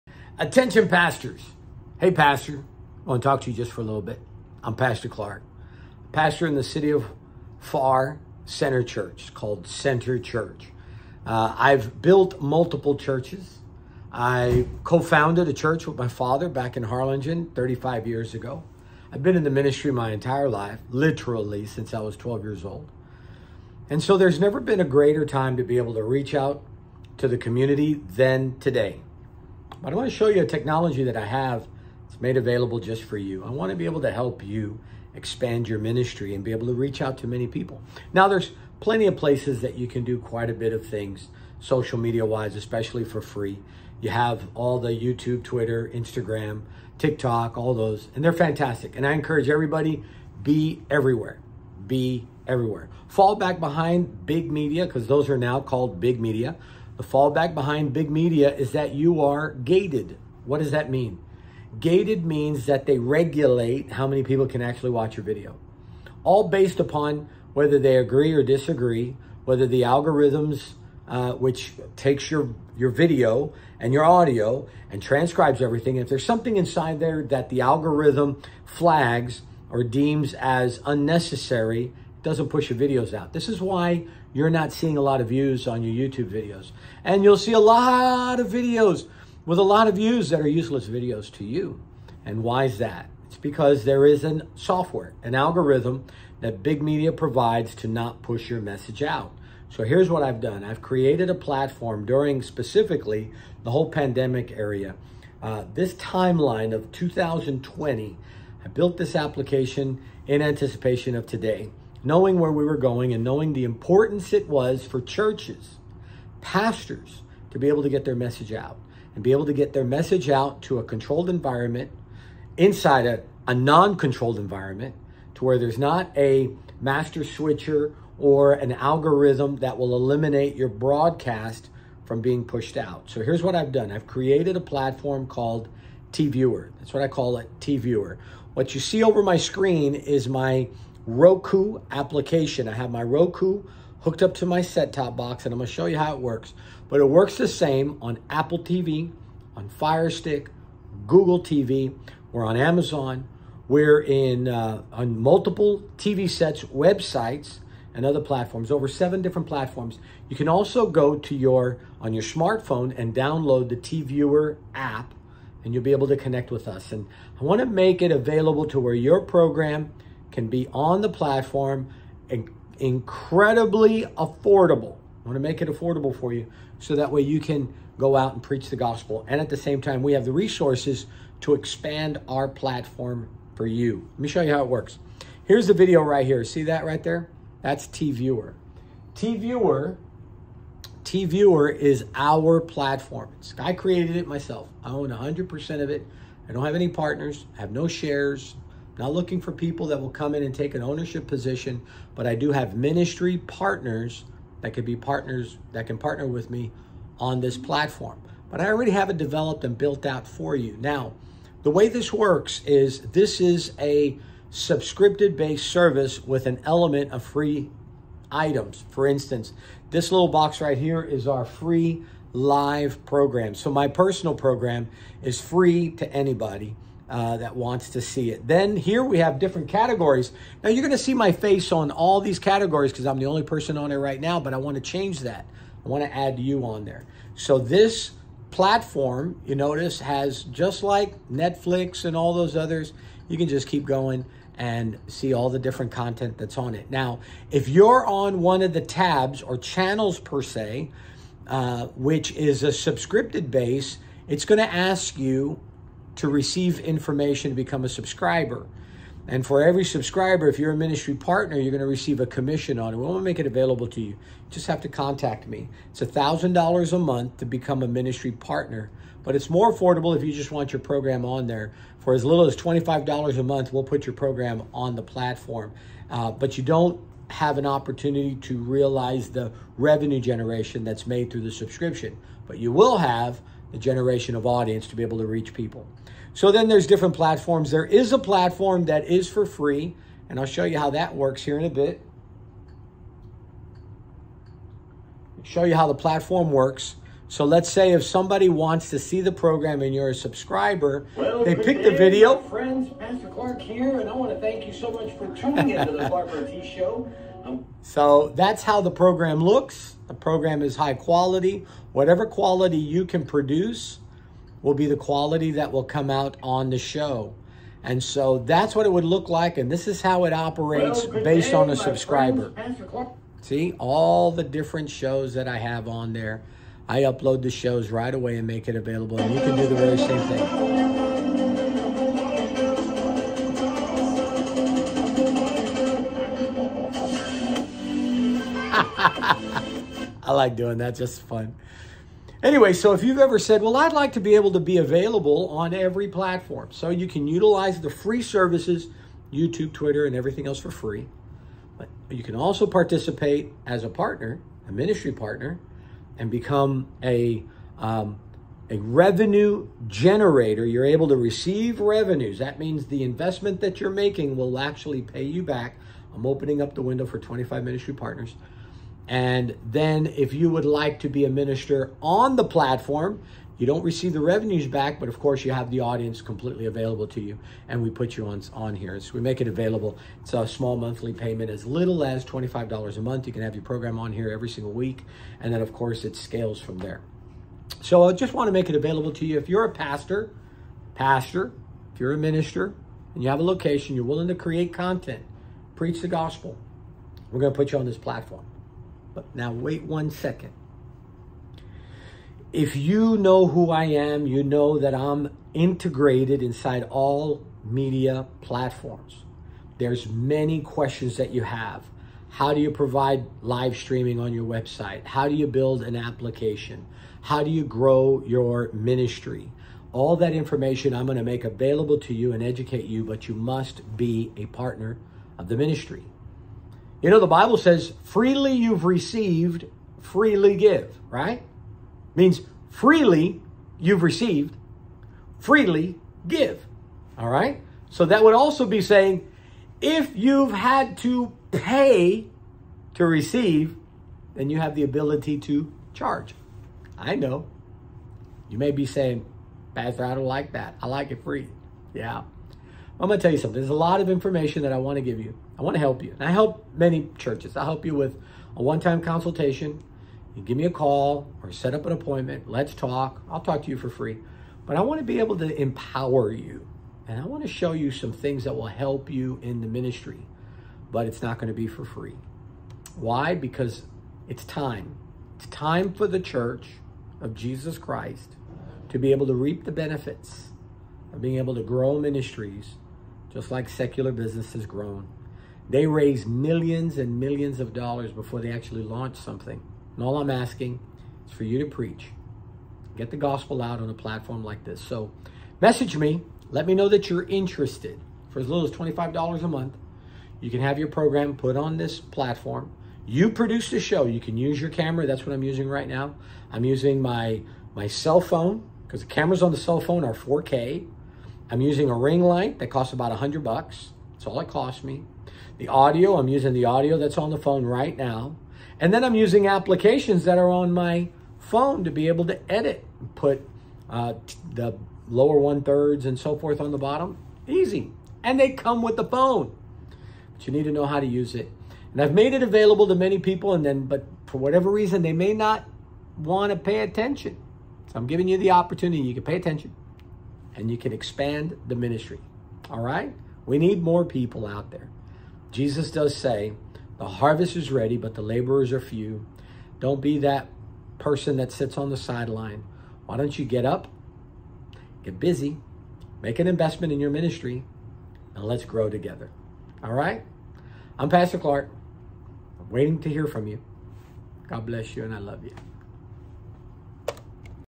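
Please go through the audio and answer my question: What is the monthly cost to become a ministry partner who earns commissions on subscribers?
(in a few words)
$1,000.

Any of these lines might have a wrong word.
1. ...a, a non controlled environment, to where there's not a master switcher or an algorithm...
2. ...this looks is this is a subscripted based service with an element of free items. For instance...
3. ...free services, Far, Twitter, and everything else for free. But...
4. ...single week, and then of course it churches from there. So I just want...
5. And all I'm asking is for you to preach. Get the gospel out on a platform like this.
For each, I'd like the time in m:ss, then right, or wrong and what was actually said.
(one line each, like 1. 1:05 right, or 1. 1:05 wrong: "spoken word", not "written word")
1. 2:03 right
2. 3:31 wrong: "works", not "looks"
3. 5:47 wrong: "YouTube", not "Far"
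4. 6:24 wrong: "scales", not "churches"
5. 8:09 right.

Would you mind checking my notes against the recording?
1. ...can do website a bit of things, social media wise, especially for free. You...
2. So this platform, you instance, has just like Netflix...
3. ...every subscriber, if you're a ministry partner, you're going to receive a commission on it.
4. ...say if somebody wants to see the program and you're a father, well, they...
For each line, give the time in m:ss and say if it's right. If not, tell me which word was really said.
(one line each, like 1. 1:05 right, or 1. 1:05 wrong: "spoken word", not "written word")
1. 0:39 wrong: "quite", not "website"
2. 3:57 wrong: "notice", not "instance"
3. 4:19 right
4. 4:57 wrong: "subscriber", not "father".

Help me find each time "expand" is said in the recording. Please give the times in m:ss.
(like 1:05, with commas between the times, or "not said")
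0:35, 3:01, 9:00.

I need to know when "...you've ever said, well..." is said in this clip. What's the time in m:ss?
5:43.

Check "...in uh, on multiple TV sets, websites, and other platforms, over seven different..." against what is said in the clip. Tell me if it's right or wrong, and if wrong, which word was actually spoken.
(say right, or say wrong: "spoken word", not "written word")
right.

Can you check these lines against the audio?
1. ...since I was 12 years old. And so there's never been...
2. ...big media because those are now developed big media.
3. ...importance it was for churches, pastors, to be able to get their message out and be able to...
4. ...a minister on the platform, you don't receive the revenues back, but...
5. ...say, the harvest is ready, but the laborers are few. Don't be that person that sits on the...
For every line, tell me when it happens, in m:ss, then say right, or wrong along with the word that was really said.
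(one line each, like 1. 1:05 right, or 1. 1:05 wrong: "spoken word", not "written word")
1. 0:21 right
2. 0:54 wrong: "called", not "developed"
3. 1:53 right
4. 6:11 right
5. 9:06 right.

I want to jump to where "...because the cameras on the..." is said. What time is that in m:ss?
8:28.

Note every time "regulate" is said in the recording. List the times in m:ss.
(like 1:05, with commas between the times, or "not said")
1:02.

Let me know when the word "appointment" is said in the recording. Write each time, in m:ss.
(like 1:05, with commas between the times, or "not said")
7:41.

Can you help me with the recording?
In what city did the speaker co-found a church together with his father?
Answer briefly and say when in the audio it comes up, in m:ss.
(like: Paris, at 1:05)
Harlingen, at 0:16.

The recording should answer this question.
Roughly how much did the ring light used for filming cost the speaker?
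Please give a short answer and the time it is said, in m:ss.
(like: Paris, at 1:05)
$100, at 8:32.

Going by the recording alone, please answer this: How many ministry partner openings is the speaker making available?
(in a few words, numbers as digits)
25.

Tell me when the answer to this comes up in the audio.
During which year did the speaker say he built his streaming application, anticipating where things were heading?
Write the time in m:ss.
1:46.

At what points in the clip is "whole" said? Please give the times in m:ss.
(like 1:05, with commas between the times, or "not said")
1:43.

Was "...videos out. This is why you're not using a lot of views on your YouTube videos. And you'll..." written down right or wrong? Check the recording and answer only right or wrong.
wrong.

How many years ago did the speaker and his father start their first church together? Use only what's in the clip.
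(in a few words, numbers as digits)
35.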